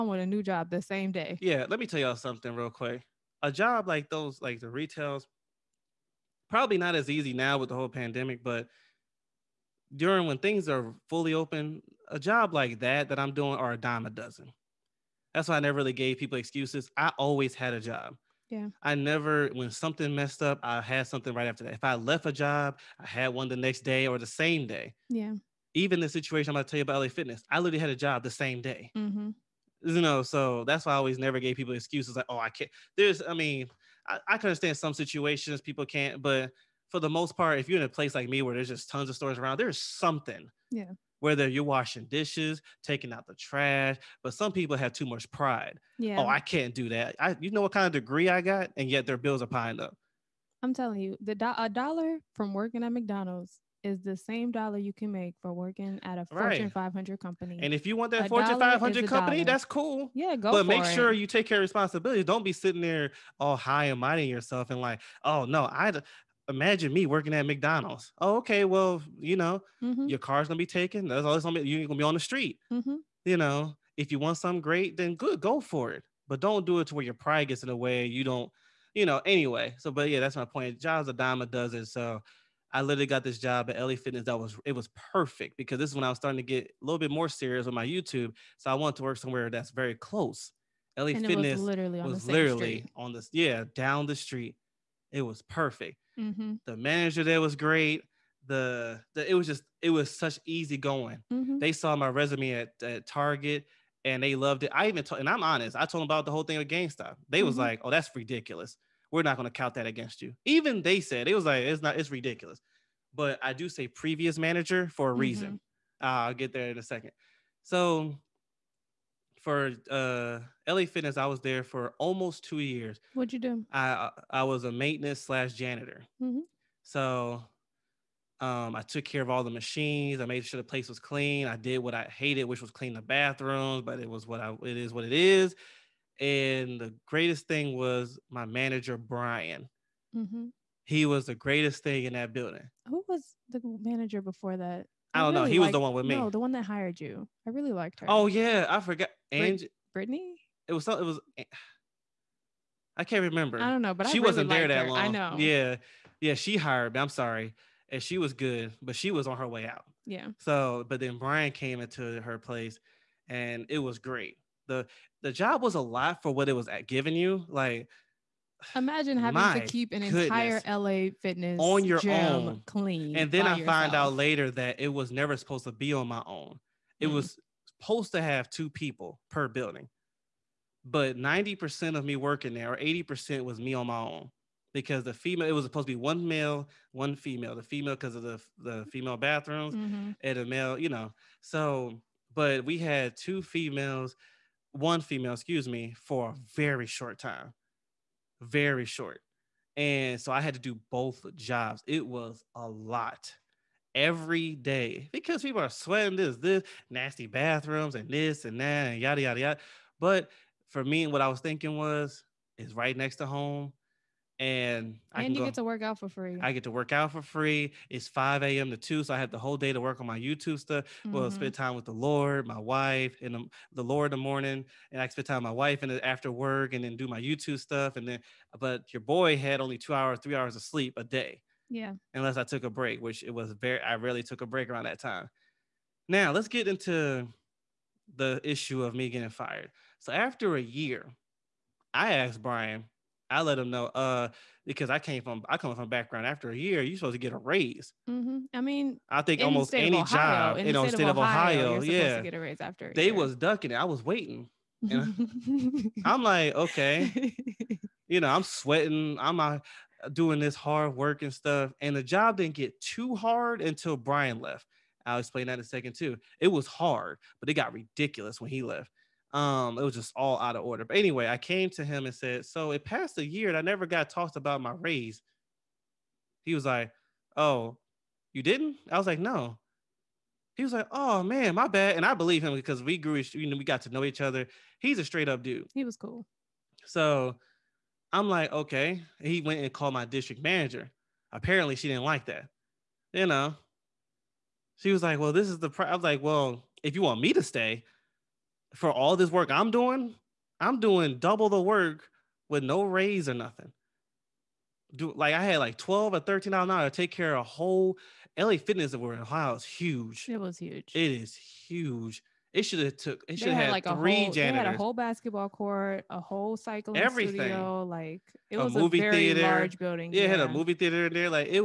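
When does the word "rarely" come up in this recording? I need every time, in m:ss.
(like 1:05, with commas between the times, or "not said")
3:53.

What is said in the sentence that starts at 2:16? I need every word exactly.
And the greatest thing was my manager Brian.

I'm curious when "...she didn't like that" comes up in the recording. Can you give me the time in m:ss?
4:51.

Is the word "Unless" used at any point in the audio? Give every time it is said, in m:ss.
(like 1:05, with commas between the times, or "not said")
3:52.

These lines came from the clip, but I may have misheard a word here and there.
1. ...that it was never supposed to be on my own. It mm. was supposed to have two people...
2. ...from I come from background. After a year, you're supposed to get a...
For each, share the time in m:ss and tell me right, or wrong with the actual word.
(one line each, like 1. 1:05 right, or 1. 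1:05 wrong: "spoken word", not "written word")
1. 2:54 right
2. 4:05 right.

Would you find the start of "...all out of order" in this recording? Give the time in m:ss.
4:30.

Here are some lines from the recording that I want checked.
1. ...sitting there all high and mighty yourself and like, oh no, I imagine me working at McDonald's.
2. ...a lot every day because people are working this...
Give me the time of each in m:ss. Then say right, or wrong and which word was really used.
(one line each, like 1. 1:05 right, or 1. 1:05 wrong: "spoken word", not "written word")
1. 1:02 right
2. 3:22 wrong: "sweating", not "working".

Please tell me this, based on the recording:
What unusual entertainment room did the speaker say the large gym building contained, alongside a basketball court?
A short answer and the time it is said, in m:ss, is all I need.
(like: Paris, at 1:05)
movie theater, at 5:20.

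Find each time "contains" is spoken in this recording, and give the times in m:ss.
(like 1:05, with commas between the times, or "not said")
not said.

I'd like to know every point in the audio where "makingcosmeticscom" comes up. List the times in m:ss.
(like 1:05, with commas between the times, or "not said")
not said.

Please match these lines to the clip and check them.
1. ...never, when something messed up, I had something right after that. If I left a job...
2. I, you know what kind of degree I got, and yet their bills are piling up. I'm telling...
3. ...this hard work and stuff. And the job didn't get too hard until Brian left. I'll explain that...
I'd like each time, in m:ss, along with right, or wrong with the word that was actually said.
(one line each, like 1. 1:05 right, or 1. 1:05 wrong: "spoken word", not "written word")
1. 0:18 right
2. 0:47 right
3. 4:20 right.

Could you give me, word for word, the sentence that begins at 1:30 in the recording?
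LA and Fitness was literally on was the literally street.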